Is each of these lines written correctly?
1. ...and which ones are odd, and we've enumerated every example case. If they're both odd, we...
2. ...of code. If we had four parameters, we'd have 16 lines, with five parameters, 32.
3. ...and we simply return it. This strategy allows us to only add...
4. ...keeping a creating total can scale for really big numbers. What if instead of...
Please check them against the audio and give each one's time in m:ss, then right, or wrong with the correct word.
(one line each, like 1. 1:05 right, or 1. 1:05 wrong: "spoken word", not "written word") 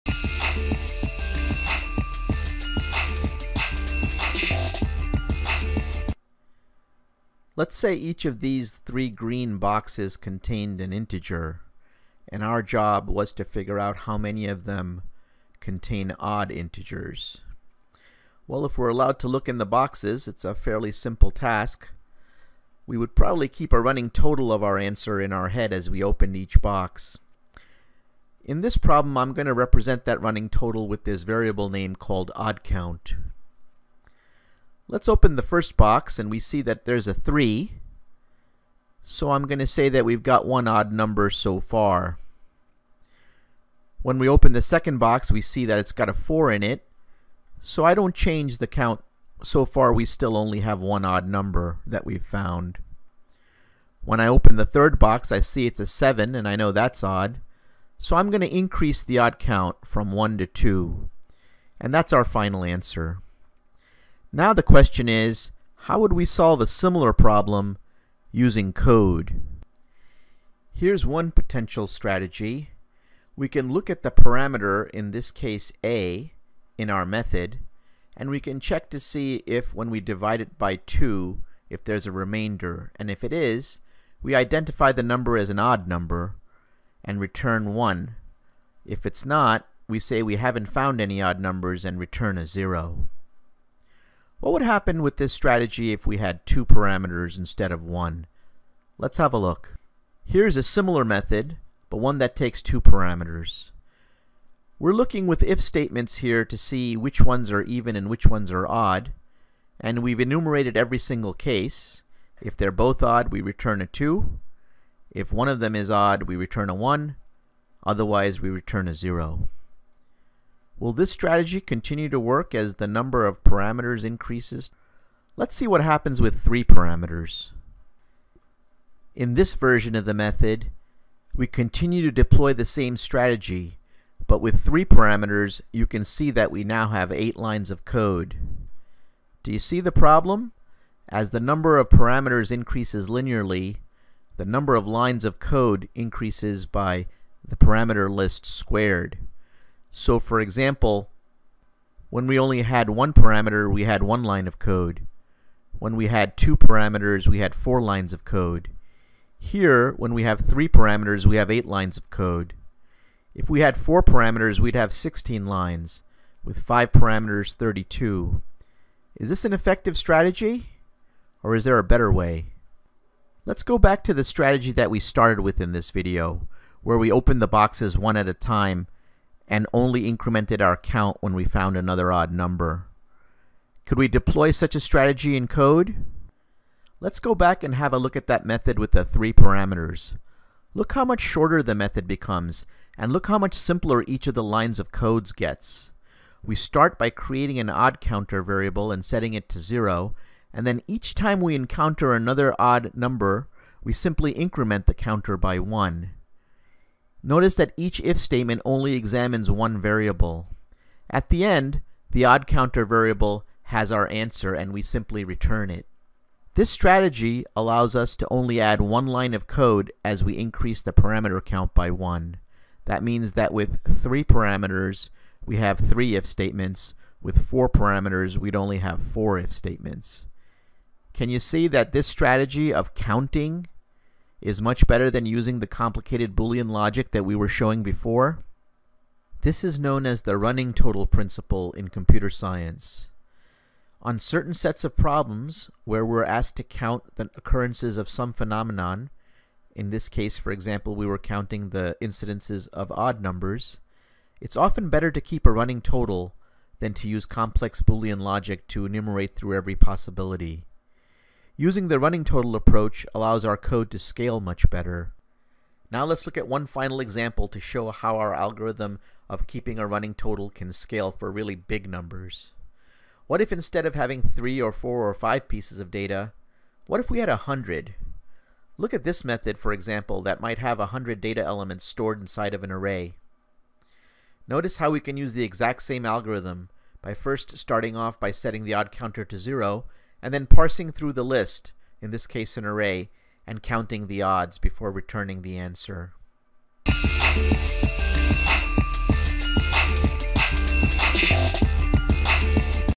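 1. 1:47 wrong: "single", not "example"
2. 2:41 right
3. 3:34 right
4. 4:29 wrong: "running", not "creating".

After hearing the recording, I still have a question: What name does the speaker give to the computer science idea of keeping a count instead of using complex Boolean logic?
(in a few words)
running total principle.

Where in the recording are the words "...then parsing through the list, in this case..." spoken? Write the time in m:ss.
4:50.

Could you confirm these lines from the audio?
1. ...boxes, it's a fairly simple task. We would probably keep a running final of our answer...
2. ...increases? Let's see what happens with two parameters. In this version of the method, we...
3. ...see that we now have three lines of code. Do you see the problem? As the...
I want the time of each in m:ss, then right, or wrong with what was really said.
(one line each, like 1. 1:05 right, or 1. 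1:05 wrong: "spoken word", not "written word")
1. 0:19 wrong: "total", not "final"
2. 2:04 wrong: "three", not "two"
3. 2:16 wrong: "eight", not "three".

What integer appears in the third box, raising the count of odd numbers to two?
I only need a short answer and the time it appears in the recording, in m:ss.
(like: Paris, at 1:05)
7, at 0:55.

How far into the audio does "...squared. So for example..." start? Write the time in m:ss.
2:28.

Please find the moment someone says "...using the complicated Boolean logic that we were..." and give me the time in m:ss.
3:55.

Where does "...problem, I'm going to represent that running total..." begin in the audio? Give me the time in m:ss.
0:28.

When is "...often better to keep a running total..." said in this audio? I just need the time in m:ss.
4:14.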